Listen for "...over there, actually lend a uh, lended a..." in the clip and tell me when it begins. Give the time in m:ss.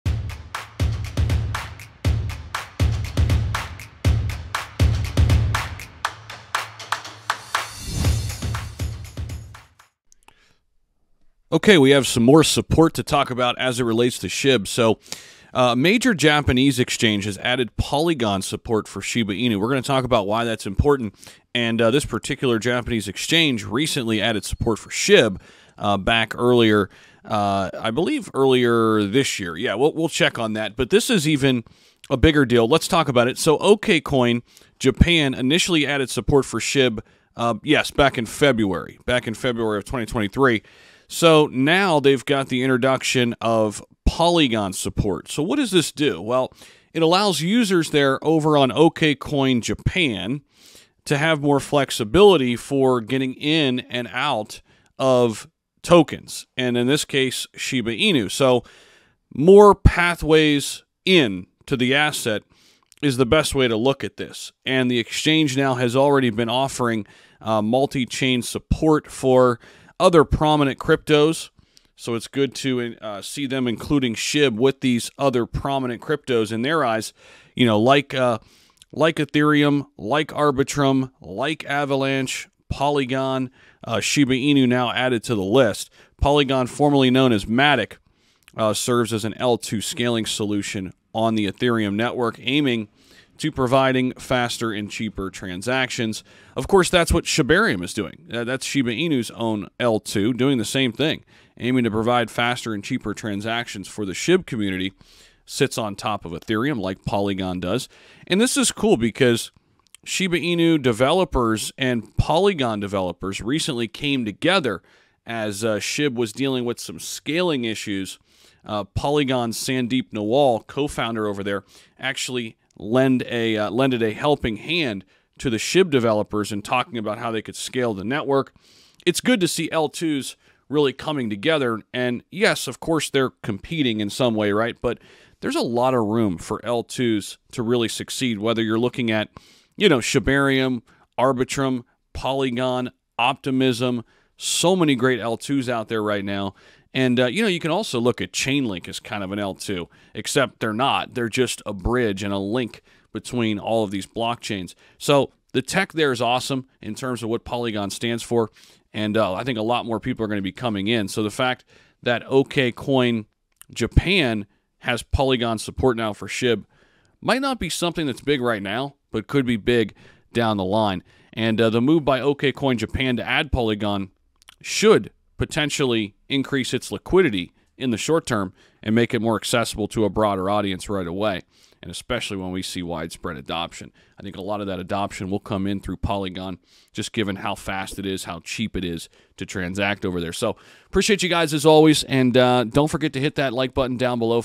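2:01.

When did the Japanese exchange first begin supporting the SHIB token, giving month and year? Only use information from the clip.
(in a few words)
February 2023.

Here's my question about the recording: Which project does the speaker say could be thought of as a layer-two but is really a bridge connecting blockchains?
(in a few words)
Chainlink.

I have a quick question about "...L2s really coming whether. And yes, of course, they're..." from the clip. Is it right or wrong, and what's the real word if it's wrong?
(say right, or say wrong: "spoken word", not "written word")
wrong: "together", not "whether".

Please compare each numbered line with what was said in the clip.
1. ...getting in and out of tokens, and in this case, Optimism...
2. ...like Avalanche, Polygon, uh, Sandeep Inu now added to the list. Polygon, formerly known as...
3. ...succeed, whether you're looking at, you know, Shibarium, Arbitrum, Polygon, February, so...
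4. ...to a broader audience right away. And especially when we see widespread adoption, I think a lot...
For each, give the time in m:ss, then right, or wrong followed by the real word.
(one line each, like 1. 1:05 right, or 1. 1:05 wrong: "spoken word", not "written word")
1. 0:53 wrong: "Shiba", not "Optimism"
2. 1:21 wrong: "Shiba", not "Sandeep"
3. 2:17 wrong: "Optimism", not "February"
4. 2:59 right.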